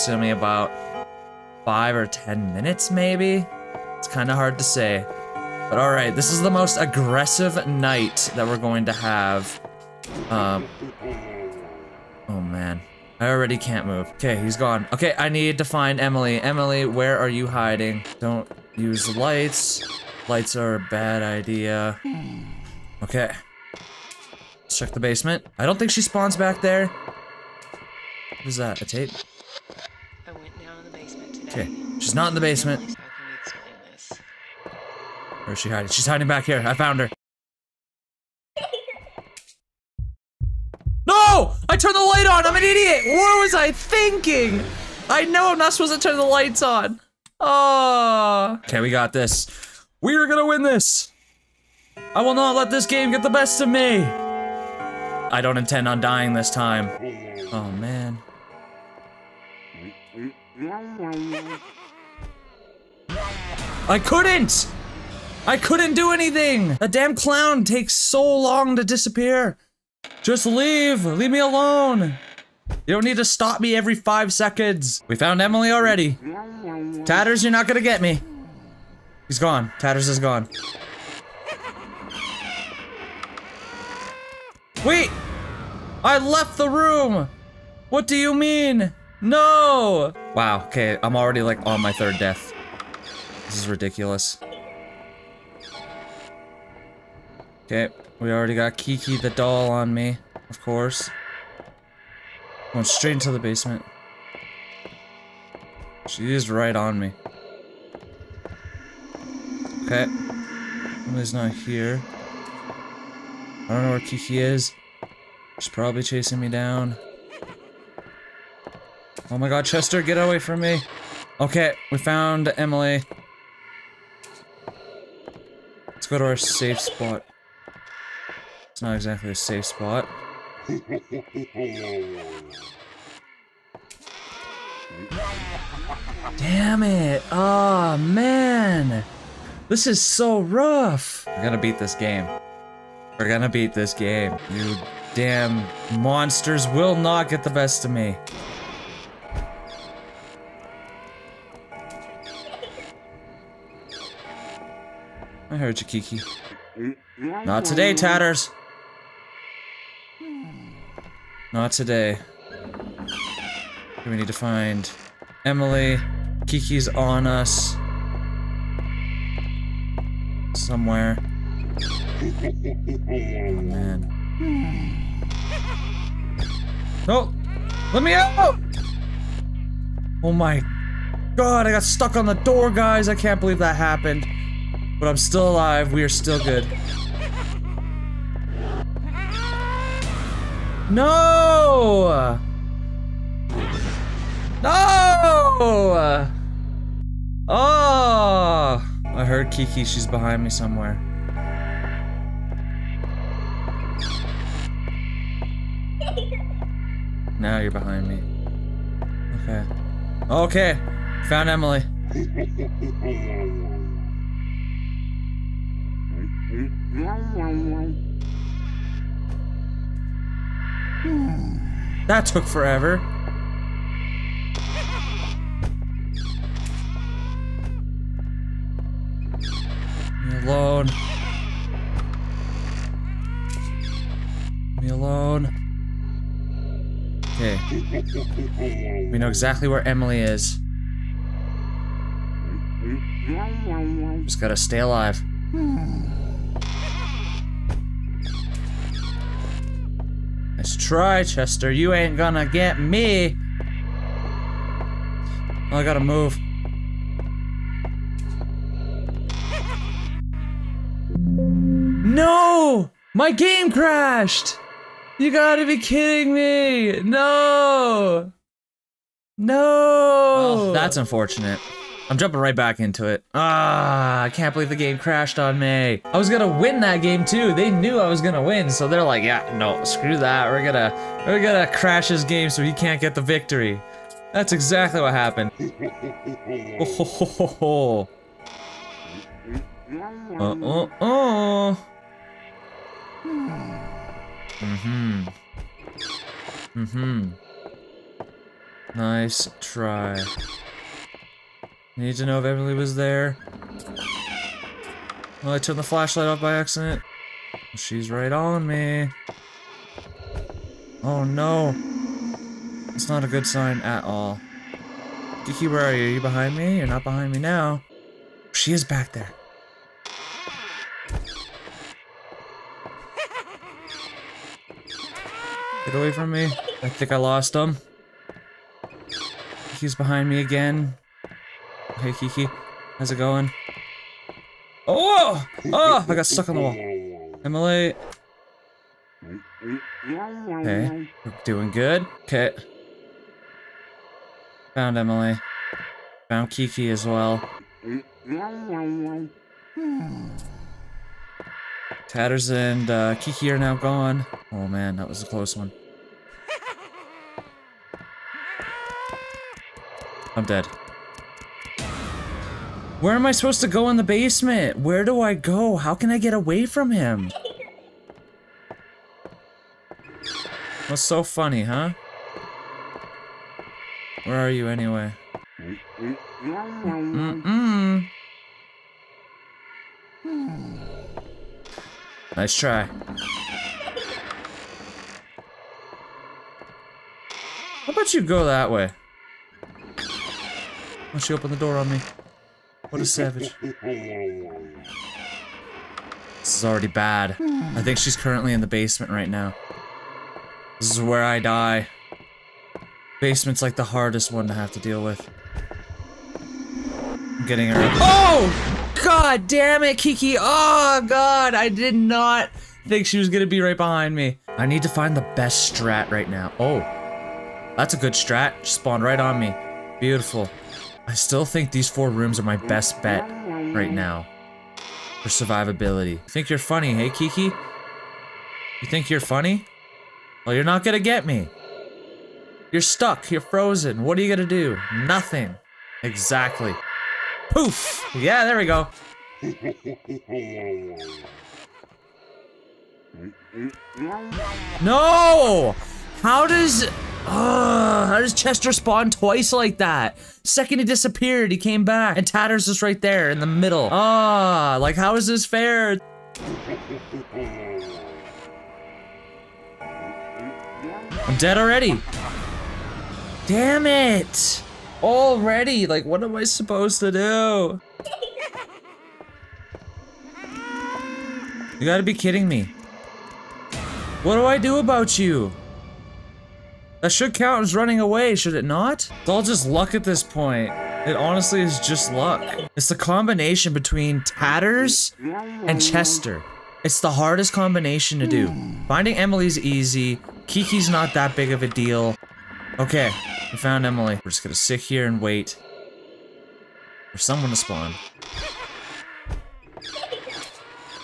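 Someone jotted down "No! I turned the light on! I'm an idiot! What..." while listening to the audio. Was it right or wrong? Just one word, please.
right.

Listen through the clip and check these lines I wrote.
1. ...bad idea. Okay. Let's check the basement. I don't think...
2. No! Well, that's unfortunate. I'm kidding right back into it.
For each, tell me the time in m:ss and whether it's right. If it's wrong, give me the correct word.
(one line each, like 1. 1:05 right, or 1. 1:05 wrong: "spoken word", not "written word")
1. 0:20 right
2. 4:29 wrong: "jumping", not "kidding".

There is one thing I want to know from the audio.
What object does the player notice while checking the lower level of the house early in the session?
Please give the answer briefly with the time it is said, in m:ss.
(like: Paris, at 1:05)
A tape, at 0:28.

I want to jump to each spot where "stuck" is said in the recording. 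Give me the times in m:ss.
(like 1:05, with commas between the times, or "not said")
3:01, 5:36, 7:12.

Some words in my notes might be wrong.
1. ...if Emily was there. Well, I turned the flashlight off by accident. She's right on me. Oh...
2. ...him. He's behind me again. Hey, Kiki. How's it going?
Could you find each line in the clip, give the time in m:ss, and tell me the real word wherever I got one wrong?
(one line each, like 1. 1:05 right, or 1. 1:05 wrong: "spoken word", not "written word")
1. 5:02 right
2. 5:27 right.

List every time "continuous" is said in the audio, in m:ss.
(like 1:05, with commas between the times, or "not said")
not said.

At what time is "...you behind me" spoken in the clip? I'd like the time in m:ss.
5:16.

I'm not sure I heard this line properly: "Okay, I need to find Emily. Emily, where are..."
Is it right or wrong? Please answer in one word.
right.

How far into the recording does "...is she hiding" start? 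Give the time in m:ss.
0:35.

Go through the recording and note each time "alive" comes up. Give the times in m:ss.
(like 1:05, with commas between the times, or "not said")
3:05, 4:04.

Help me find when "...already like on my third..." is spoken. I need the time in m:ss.
1:31.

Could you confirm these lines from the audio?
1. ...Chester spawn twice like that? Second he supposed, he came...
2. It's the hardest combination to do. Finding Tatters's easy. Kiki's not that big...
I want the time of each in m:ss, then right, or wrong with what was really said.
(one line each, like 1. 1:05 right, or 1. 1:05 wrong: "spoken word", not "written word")
1. 7:28 wrong: "disappeared", not "supposed"
2. 8:06 wrong: "Emily", not "Tatters".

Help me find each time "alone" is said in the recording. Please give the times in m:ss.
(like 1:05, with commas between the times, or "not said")
1:11, 3:50, 3:54.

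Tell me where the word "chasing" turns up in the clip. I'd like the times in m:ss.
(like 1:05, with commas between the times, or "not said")
1:56.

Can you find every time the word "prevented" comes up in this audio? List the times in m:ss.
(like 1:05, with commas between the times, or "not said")
not said.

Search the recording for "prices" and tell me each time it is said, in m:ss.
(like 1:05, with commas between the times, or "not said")
not said.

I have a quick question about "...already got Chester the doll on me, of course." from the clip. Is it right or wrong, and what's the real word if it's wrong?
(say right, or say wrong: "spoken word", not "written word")
wrong: "Kiki", not "Chester".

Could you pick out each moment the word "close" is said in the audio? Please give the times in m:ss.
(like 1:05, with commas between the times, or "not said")
5:55.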